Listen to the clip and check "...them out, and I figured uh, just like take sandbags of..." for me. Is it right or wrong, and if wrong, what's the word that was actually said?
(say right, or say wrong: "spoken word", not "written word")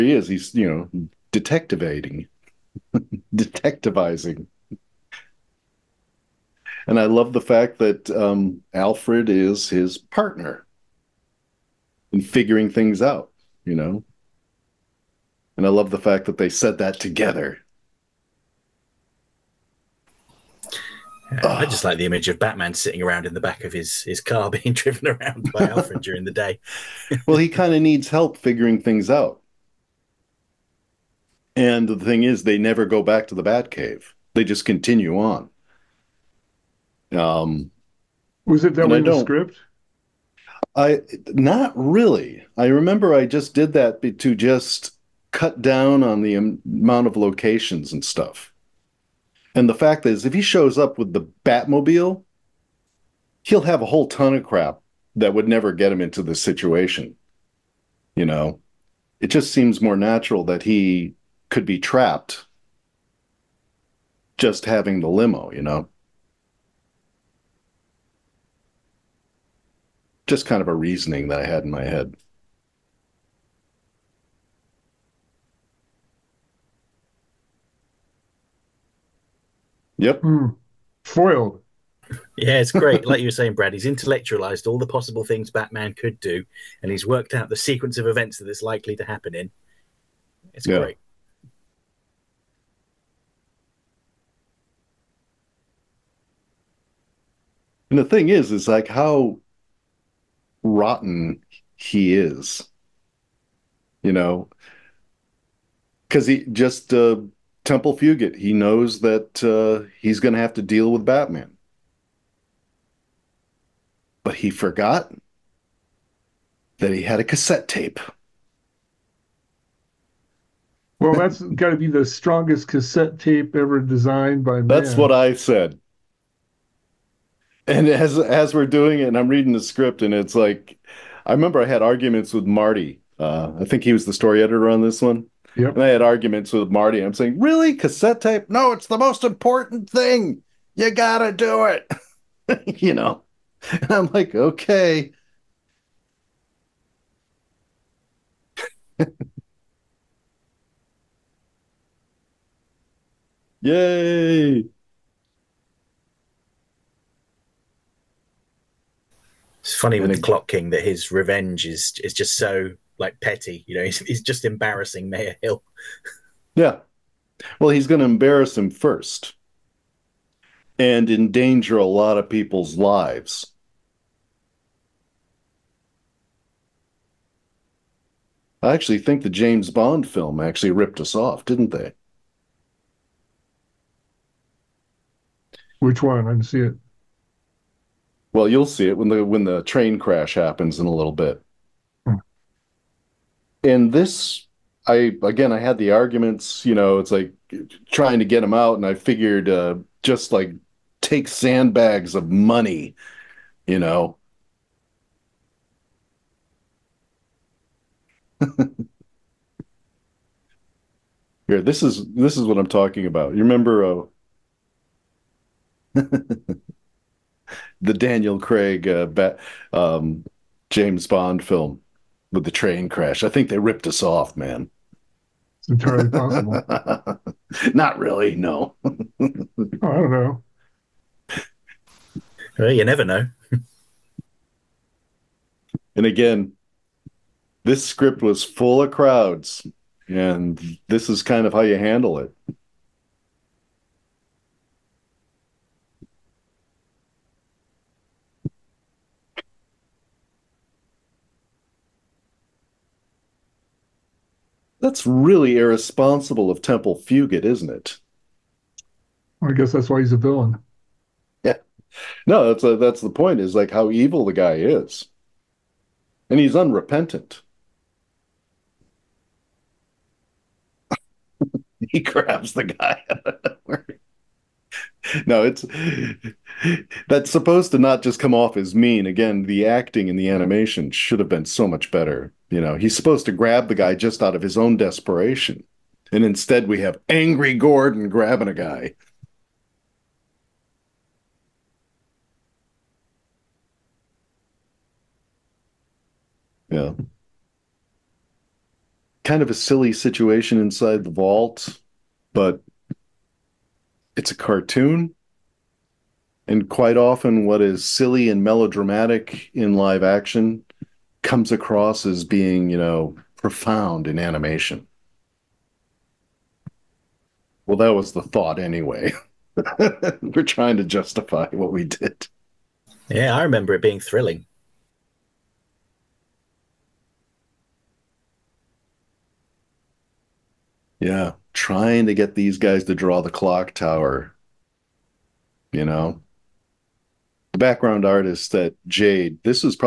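right.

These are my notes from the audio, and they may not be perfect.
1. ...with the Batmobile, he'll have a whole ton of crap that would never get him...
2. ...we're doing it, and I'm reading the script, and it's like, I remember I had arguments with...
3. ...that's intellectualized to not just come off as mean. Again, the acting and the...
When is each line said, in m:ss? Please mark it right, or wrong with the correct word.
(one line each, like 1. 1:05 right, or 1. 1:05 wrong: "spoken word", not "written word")
1. 0:50 right
2. 2:08 right
3. 4:37 wrong: "supposed", not "intellectualized".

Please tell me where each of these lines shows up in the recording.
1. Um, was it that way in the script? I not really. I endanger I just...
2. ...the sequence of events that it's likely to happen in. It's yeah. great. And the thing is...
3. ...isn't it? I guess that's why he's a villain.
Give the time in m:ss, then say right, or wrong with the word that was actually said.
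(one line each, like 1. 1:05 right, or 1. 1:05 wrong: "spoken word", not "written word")
1. 0:37 wrong: "remember", not "endanger"
2. 1:27 right
3. 4:17 right.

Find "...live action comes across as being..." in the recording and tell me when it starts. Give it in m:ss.
5:09.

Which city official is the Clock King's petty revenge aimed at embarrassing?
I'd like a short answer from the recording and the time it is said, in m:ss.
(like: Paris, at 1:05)
Mayor Hill, at 2:45.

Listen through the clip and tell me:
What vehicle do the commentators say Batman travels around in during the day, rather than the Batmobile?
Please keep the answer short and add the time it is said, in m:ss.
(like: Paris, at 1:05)
limo, at 1:05.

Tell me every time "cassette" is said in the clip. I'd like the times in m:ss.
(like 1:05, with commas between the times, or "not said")
1:57, 2:02, 2:17.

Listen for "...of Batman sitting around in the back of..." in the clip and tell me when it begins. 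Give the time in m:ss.
0:22.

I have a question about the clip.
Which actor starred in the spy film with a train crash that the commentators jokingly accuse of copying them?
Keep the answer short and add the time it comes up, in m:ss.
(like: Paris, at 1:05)
Daniel Craig, at 3:37.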